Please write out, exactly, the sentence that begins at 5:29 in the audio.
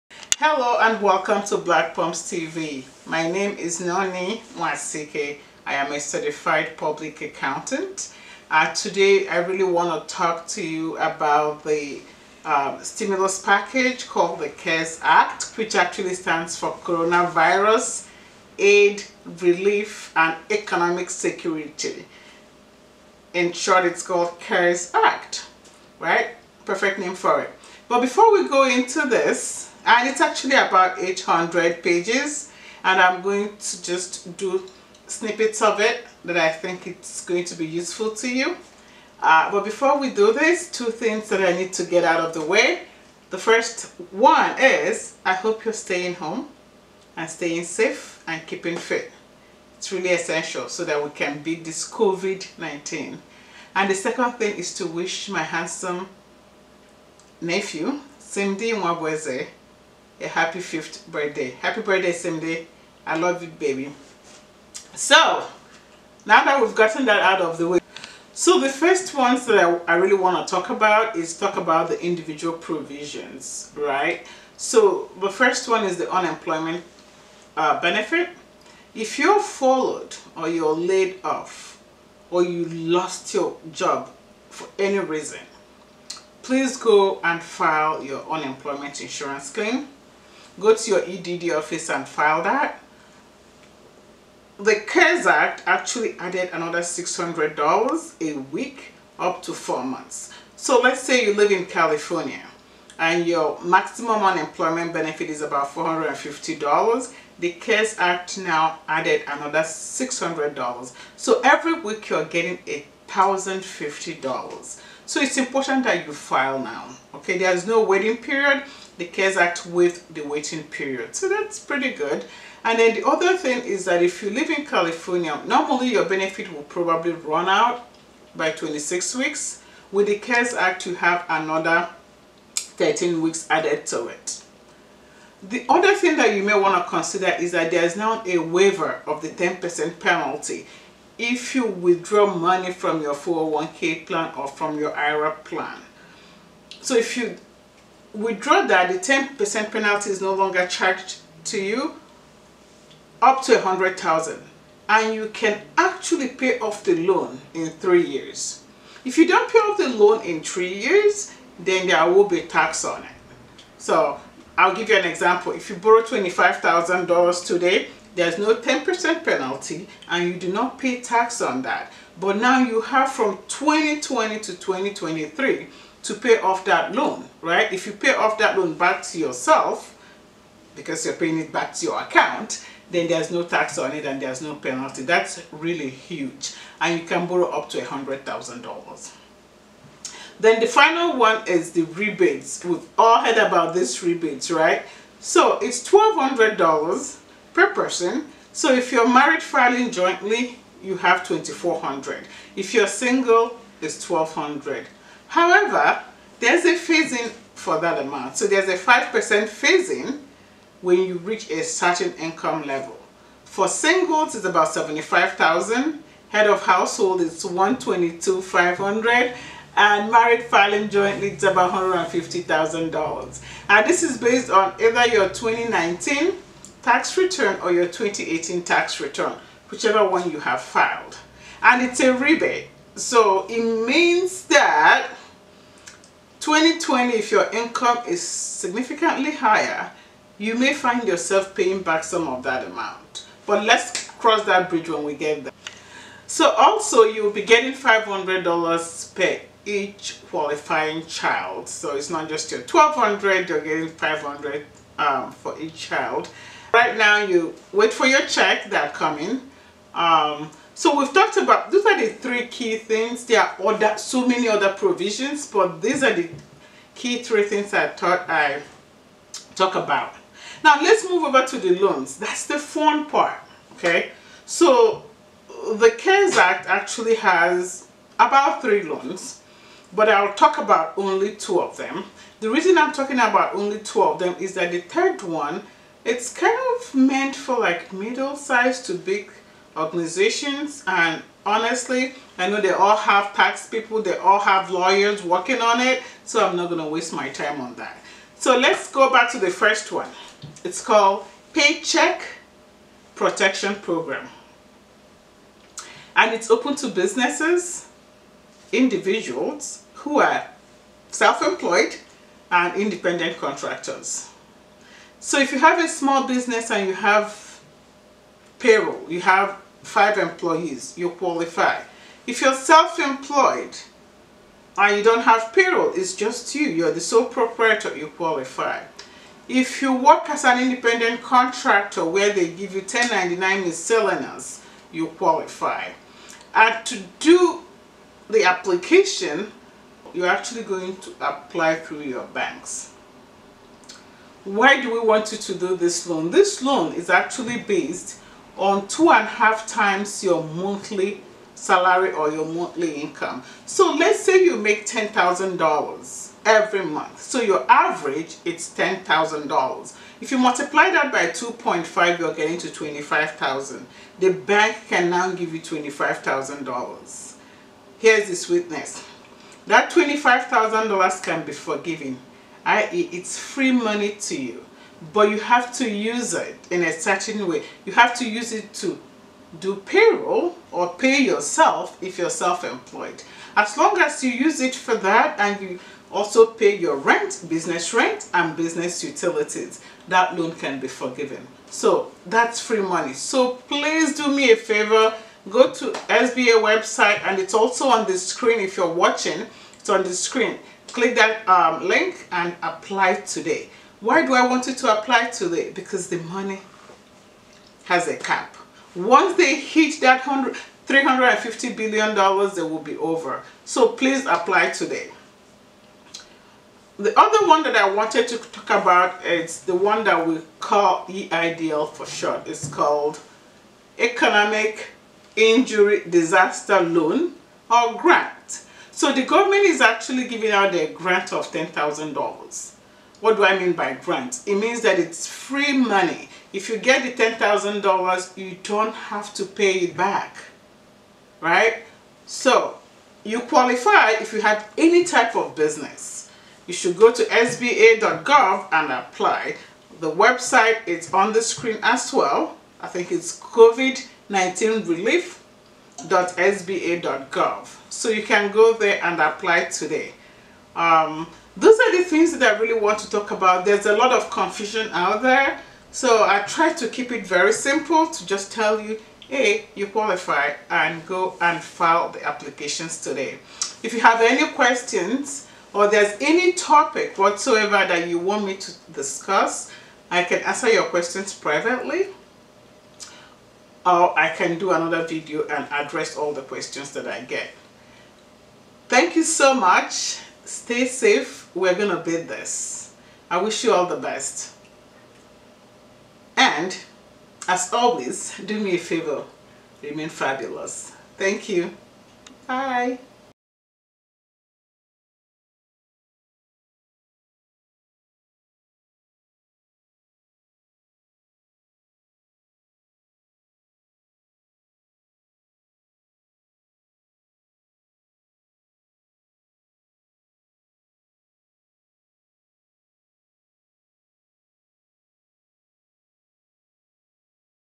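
If you work as an independent contractor where they give you 1099 miscellaneous, you qualify.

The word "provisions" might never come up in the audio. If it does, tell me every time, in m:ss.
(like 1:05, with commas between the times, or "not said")
1:12, 4:24.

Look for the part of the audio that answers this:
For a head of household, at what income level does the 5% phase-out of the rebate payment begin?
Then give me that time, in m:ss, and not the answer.
3:37.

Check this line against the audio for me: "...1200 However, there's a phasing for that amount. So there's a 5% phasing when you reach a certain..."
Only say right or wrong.
right.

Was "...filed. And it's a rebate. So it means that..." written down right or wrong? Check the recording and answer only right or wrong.
right.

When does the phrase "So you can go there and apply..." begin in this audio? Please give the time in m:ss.
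7:37.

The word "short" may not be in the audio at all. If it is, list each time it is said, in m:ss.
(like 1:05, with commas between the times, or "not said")
0:23, 7:02.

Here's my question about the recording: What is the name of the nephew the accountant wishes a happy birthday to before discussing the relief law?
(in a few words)
Simdi Mwabweze.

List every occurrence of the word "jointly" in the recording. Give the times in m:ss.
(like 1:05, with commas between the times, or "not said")
3:19, 3:40.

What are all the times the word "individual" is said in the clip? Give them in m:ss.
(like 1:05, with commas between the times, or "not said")
1:12, 5:08.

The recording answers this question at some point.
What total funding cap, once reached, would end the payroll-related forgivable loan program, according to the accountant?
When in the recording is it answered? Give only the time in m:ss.
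6:50.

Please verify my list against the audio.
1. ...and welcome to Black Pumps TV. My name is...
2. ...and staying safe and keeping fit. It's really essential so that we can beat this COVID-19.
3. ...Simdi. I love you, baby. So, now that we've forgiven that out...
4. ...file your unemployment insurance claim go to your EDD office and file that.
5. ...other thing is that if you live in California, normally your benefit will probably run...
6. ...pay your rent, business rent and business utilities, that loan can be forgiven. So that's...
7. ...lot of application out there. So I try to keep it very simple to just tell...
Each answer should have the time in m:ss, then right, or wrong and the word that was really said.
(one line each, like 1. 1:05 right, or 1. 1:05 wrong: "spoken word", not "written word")
1. 0:00 right
2. 0:47 right
3. 1:02 wrong: "gotten", not "forgiven"
4. 1:27 right
5. 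2:03 right
6. 6:26 right
7. 7:43 wrong: "confusion", not "application".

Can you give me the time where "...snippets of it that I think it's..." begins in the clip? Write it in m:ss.
0:35.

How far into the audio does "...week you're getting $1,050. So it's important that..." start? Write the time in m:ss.
1:51.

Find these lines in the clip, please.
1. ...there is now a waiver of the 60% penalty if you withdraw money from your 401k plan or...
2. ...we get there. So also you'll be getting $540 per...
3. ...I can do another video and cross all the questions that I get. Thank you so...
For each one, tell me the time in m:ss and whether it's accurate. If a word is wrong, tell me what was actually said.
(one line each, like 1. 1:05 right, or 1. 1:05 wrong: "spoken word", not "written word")
1. 2:17 wrong: "10", not "60"
2. 4:05 wrong: "500", not "540"
3. 8:04 wrong: "address", not "cross".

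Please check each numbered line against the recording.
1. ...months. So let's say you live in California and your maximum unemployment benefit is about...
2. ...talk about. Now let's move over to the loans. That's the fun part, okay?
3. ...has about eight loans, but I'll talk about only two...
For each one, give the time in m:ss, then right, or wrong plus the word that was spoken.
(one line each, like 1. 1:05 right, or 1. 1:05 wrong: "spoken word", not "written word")
1. 1:39 right
2. 4:29 right
3. 4:37 wrong: "three", not "eight".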